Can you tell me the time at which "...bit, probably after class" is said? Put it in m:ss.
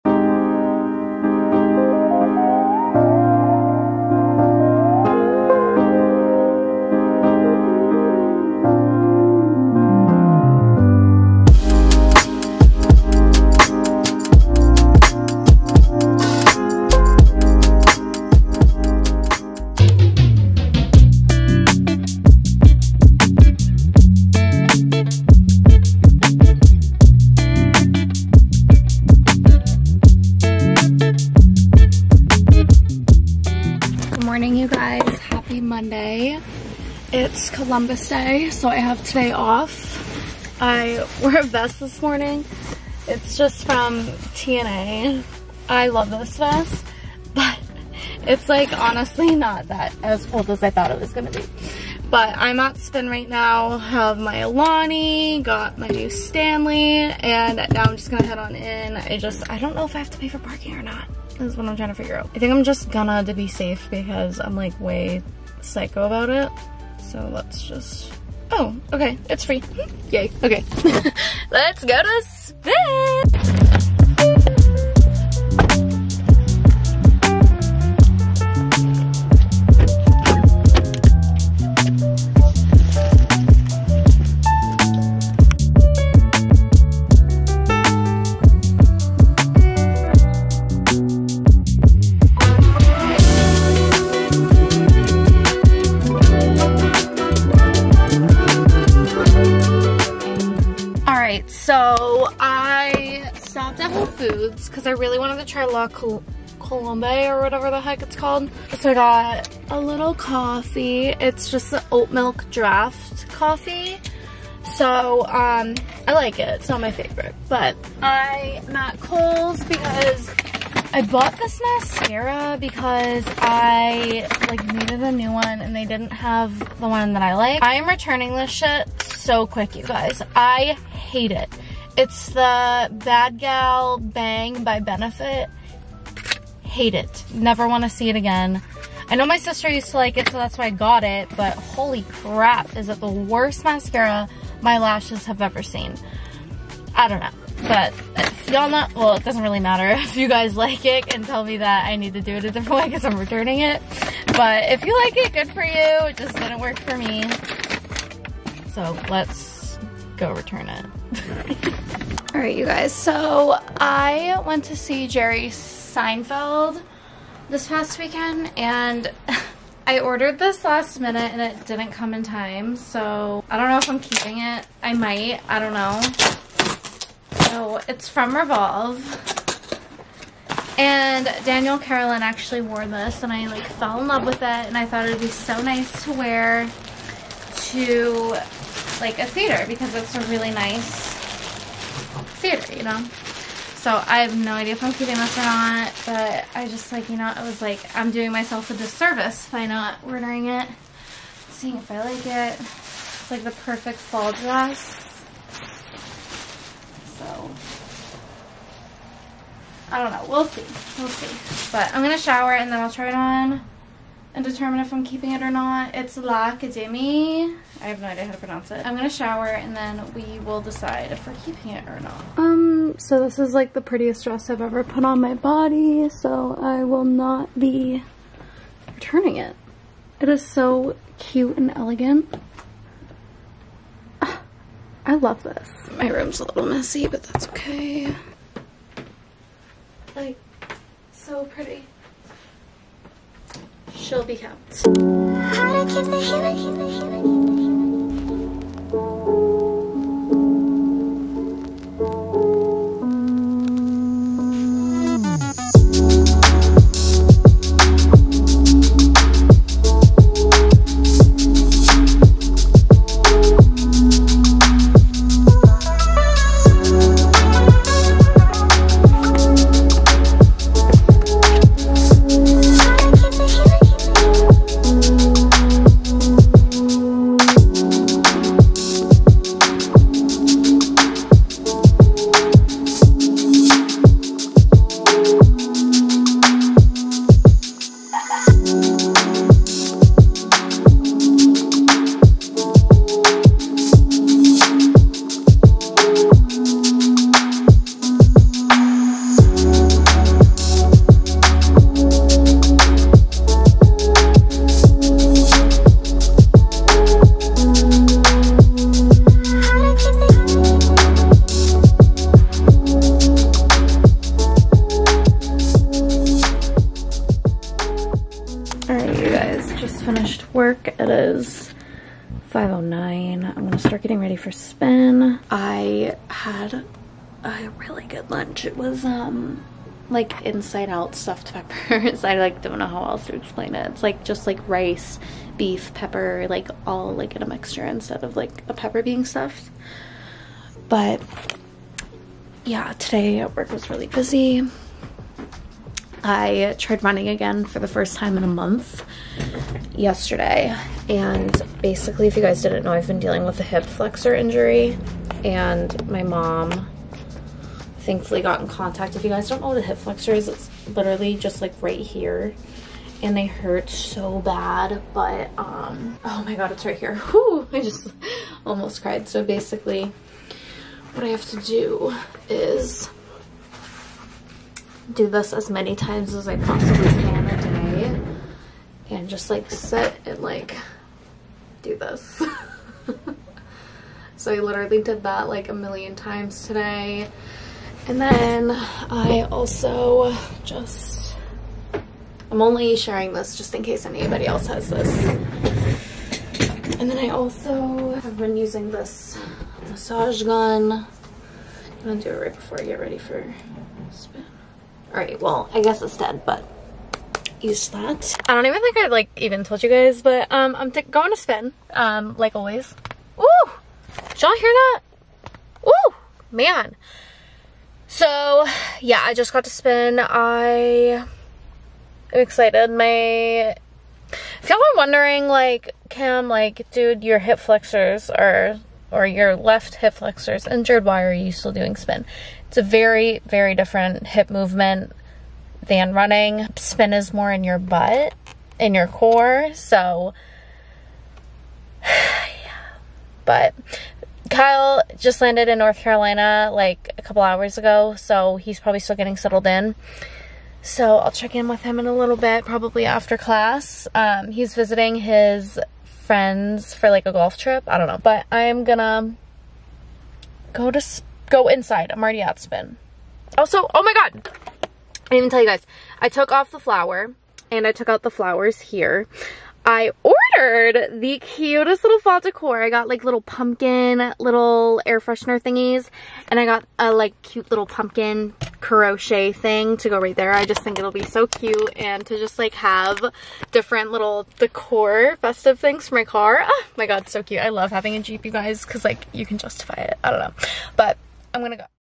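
7:32.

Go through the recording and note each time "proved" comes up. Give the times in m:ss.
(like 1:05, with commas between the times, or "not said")
not said.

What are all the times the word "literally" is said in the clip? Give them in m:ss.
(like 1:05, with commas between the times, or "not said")
6:00, 6:24.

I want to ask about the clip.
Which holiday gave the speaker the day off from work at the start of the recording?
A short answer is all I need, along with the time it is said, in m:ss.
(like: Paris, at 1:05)
Columbus Day, at 0:37.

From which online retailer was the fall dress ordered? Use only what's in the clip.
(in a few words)
Revolve.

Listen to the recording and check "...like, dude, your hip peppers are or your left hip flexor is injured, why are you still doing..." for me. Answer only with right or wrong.
wrong.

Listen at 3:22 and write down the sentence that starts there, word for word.
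It's like the perfect fall dress.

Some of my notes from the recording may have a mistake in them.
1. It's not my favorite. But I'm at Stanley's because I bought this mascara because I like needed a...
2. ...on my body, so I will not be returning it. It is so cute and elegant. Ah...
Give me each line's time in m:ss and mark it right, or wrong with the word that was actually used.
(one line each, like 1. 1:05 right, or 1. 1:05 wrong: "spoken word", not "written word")
1. 1:56 wrong: "Kohl", not "Stanley"
2. 3:45 right.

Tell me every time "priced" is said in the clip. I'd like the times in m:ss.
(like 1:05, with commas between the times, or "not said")
not said.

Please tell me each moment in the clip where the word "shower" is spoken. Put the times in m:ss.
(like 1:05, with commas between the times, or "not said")
3:32, 3:39.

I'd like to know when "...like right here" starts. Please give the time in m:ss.
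6:01.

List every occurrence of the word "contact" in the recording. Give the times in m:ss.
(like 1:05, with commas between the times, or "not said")
5:58.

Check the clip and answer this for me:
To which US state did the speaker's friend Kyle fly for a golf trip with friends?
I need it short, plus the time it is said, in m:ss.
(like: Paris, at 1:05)
North Carolina, at 7:25.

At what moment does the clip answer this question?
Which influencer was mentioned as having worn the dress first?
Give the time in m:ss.
3:01.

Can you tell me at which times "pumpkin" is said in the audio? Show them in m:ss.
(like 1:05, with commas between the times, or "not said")
7:53, 7:57.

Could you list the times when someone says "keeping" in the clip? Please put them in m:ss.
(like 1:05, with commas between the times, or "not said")
2:53, 3:14, 3:35, 3:41.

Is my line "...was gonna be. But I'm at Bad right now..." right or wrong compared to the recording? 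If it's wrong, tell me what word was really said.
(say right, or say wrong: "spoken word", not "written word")
wrong: "Spin", not "Bad".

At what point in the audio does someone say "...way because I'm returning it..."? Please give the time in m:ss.
2:32.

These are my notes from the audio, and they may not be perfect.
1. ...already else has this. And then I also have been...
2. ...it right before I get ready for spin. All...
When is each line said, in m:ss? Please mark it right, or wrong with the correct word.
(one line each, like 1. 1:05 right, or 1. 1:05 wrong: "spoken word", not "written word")
1. 6:34 wrong: "anybody", not "already"
2. 6:42 right.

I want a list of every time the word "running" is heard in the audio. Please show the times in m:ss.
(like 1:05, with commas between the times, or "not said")
5:47, 7:16.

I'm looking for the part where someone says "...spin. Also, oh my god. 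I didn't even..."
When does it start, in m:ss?
7:42.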